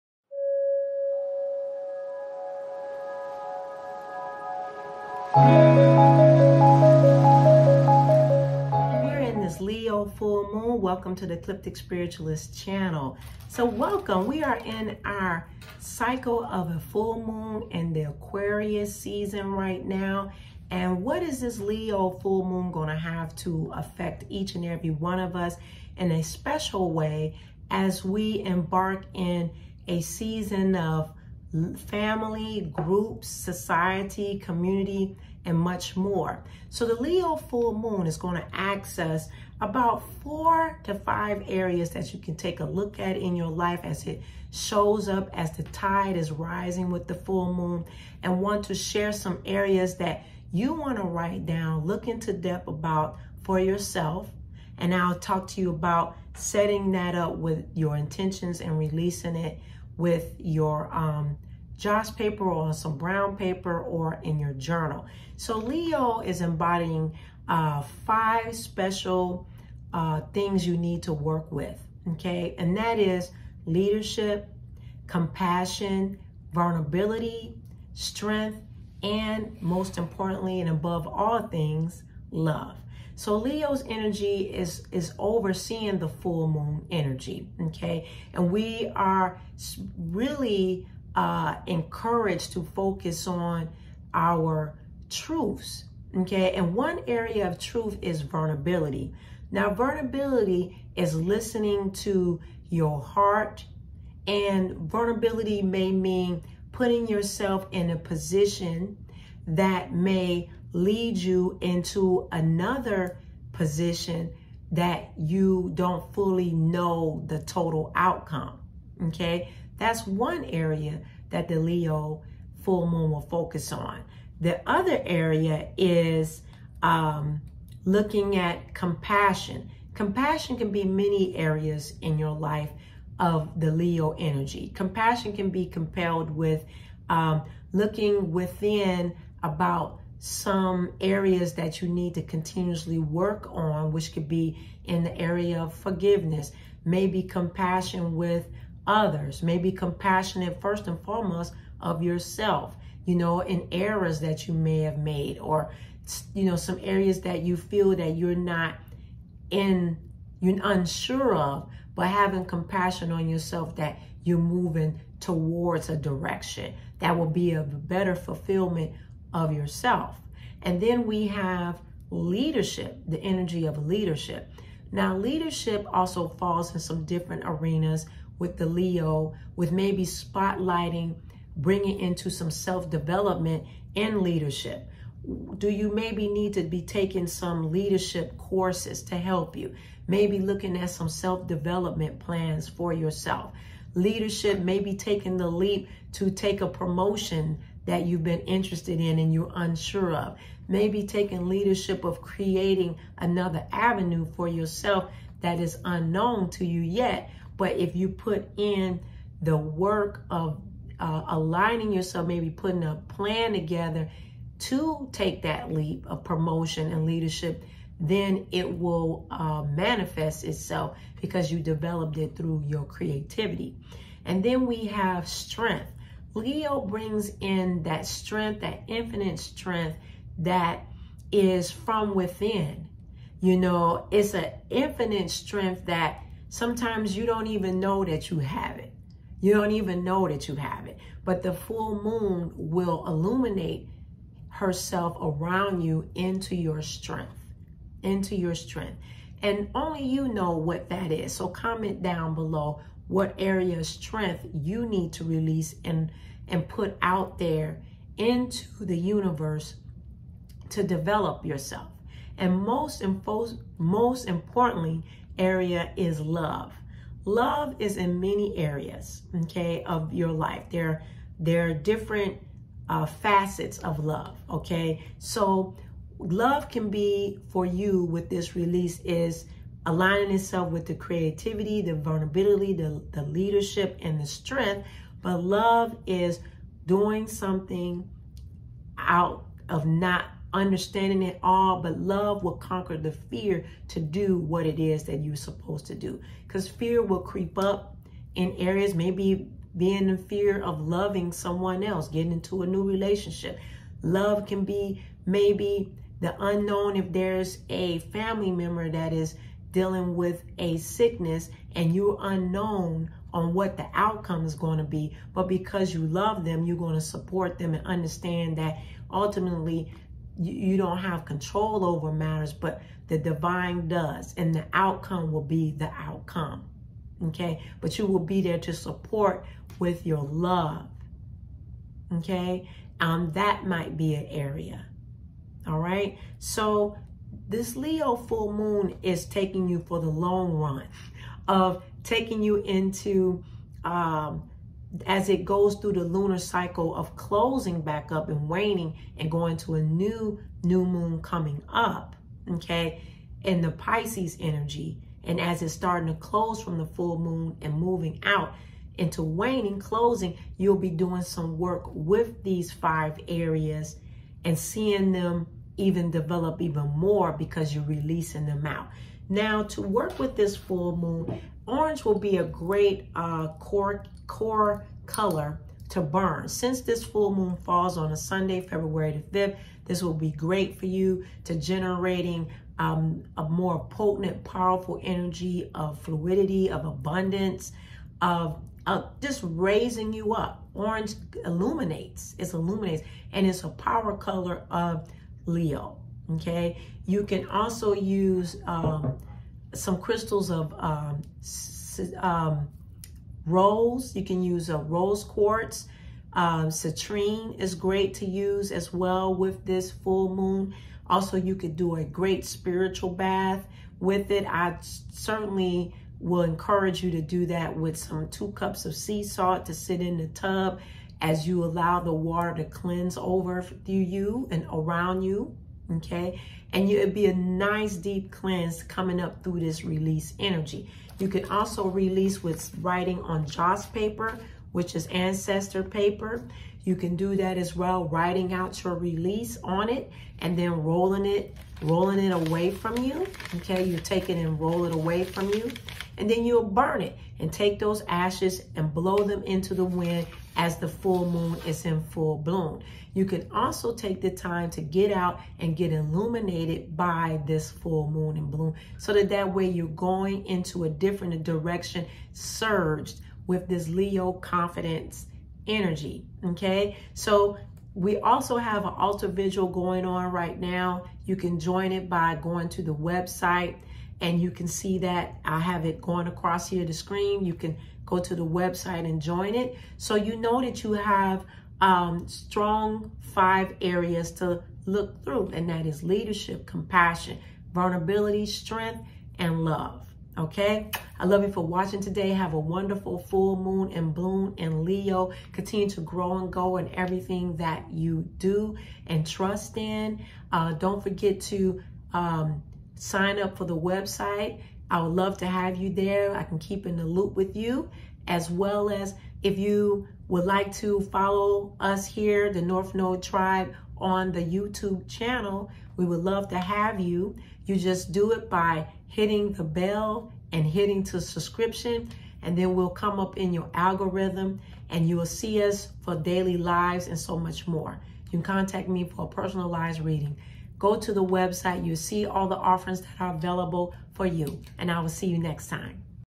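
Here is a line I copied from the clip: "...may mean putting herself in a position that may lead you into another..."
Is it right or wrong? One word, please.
wrong.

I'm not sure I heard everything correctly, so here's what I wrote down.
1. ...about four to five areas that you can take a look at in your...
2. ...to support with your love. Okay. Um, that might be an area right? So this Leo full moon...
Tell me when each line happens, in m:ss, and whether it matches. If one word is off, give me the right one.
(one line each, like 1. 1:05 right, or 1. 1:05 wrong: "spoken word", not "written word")
1. 0:39 right
2. 5:28 right.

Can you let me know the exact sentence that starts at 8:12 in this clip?
Have a wonderful full moon and bloom and Leo.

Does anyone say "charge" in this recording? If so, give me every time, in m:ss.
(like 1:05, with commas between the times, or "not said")
not said.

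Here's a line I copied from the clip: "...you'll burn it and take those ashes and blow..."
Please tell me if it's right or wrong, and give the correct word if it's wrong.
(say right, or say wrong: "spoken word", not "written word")
right.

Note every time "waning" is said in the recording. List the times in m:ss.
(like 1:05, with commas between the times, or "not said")
5:48, 5:59.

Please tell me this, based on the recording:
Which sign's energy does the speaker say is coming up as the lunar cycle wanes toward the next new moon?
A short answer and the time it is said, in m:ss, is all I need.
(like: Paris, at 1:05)
Pisces, at 5:53.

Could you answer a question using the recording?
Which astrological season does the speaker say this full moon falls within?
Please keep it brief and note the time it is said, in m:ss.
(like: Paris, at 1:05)
Aquarius, at 0:18.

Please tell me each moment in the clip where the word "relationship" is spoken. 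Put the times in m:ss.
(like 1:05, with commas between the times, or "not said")
5:02.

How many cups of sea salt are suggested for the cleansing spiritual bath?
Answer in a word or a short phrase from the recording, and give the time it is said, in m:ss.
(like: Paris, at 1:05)
2, at 6:58.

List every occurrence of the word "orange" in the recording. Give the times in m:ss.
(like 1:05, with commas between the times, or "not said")
6:11, 6:30.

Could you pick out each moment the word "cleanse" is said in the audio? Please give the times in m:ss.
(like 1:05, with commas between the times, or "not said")
7:02, 7:08.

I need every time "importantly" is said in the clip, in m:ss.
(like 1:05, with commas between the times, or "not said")
1:19, 4:24.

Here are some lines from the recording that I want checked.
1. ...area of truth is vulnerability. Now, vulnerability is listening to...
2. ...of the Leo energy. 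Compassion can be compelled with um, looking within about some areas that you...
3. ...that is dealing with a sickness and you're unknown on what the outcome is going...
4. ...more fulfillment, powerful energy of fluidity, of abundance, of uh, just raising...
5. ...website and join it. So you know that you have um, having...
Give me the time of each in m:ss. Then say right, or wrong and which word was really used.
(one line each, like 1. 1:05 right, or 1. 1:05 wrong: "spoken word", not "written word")
1. 1:37 right
2. 2:13 right
3. 5:08 right
4. 6:23 wrong: "potent", not "fulfillment"
5. 7:58 wrong: "strong", not "having".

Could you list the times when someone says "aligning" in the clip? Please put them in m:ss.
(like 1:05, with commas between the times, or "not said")
3:31, 4:39.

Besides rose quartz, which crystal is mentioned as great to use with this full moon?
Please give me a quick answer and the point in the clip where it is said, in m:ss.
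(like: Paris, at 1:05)
citrine, at 6:46.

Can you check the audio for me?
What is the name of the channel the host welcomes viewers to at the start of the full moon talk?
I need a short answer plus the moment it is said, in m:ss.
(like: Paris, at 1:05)
Ecliptic Spiritualist, at 0:11.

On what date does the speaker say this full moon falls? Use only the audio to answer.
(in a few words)
February 5th.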